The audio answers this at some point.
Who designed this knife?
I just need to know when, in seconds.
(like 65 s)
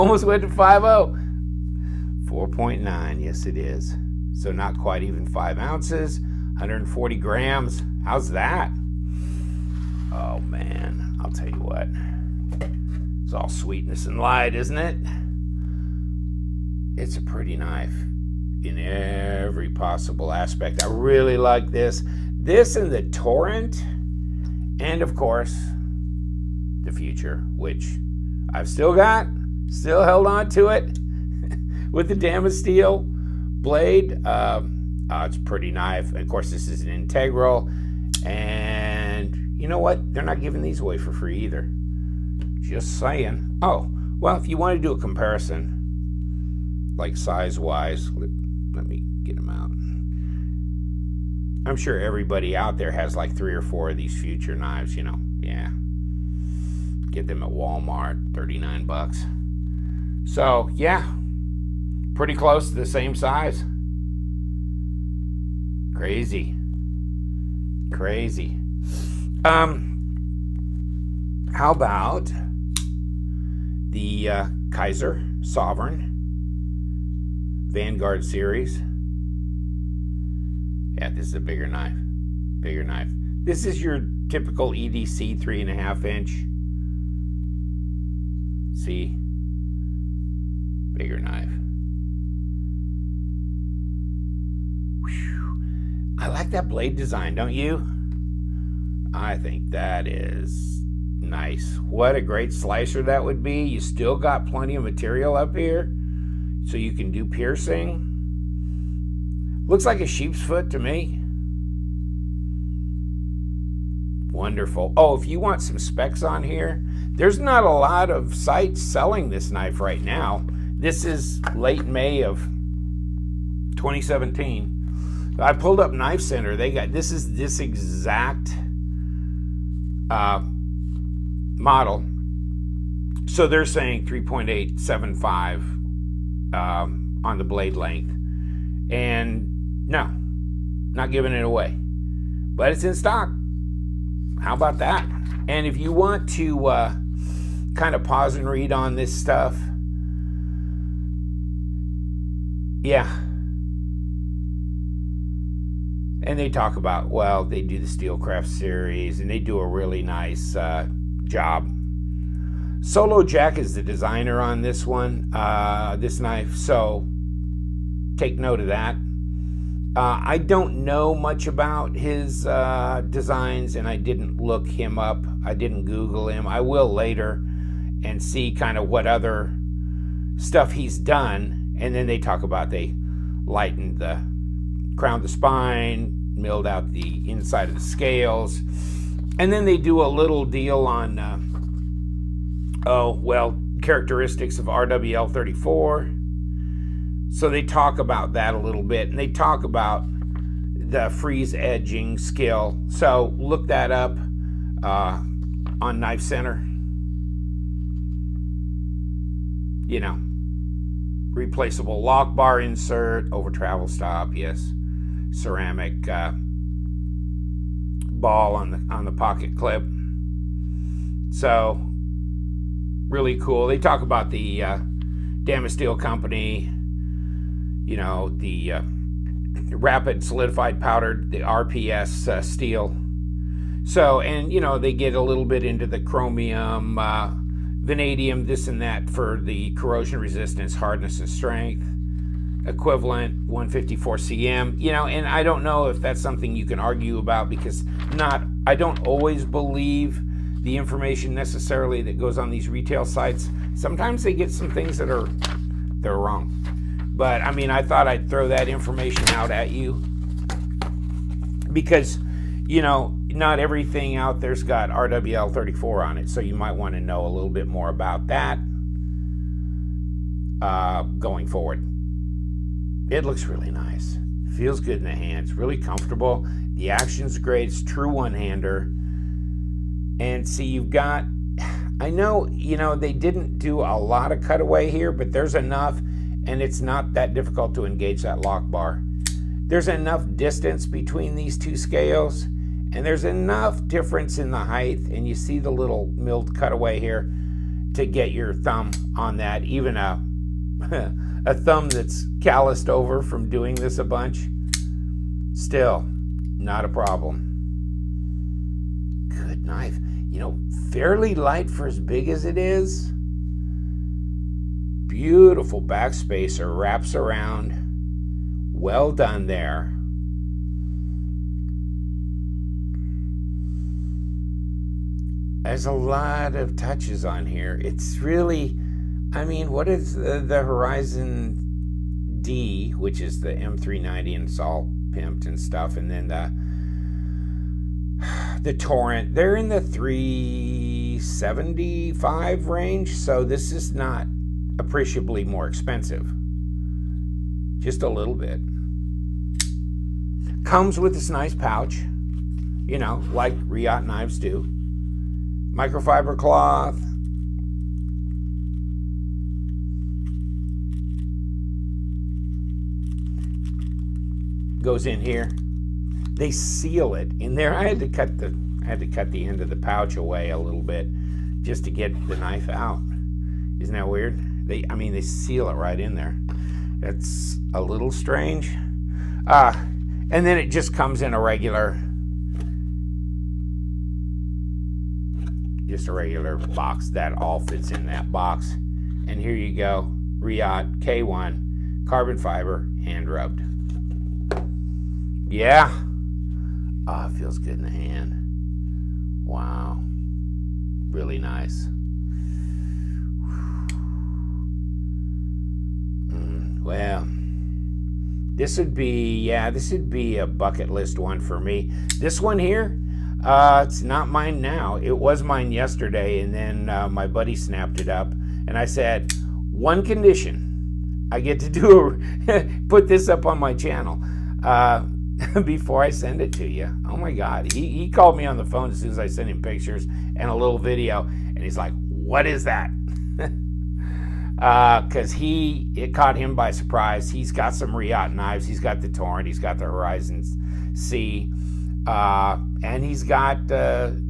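162 s.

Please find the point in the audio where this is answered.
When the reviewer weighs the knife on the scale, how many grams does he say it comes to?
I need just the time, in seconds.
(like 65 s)
6 s.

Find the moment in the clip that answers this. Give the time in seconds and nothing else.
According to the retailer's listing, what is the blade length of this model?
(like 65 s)
134 s.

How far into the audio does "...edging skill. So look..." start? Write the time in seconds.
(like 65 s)
201 s.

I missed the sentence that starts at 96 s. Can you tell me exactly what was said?
I like that blade design, don't you?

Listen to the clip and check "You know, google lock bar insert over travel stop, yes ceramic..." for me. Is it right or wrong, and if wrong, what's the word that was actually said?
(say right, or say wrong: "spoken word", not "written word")
wrong: "replaceable", not "google".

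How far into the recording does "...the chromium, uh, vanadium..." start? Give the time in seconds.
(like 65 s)
235 s.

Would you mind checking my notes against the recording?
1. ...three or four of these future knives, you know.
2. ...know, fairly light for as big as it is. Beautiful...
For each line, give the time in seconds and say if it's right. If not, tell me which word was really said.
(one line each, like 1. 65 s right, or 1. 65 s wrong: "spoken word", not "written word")
1. 53 s right
2. 310 s right.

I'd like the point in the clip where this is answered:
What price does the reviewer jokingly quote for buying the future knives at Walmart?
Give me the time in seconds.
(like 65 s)
58 s.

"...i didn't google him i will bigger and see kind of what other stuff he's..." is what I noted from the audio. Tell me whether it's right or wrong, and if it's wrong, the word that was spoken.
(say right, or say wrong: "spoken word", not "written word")
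wrong: "later", not "bigger".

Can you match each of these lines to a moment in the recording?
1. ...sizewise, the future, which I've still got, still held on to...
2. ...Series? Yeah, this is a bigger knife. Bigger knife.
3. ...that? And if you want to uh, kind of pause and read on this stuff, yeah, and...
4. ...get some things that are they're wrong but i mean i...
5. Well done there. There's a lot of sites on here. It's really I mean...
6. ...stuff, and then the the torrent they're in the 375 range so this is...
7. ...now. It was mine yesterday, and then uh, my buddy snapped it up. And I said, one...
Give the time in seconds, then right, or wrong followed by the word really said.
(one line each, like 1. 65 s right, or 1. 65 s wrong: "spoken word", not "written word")
1. 25 s wrong: "course", not "sizewise"
2. 78 s right
3. 144 s right
4. 254 s right
5. 318 s wrong: "touches", not "sites"
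6. 335 s right
7. 414 s right.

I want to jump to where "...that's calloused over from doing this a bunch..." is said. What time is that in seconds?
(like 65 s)
301 s.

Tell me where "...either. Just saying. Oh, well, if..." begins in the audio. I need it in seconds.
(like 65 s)
41 s.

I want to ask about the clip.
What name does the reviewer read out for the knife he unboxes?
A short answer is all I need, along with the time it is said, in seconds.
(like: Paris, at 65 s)
Riot K1, at 390 s.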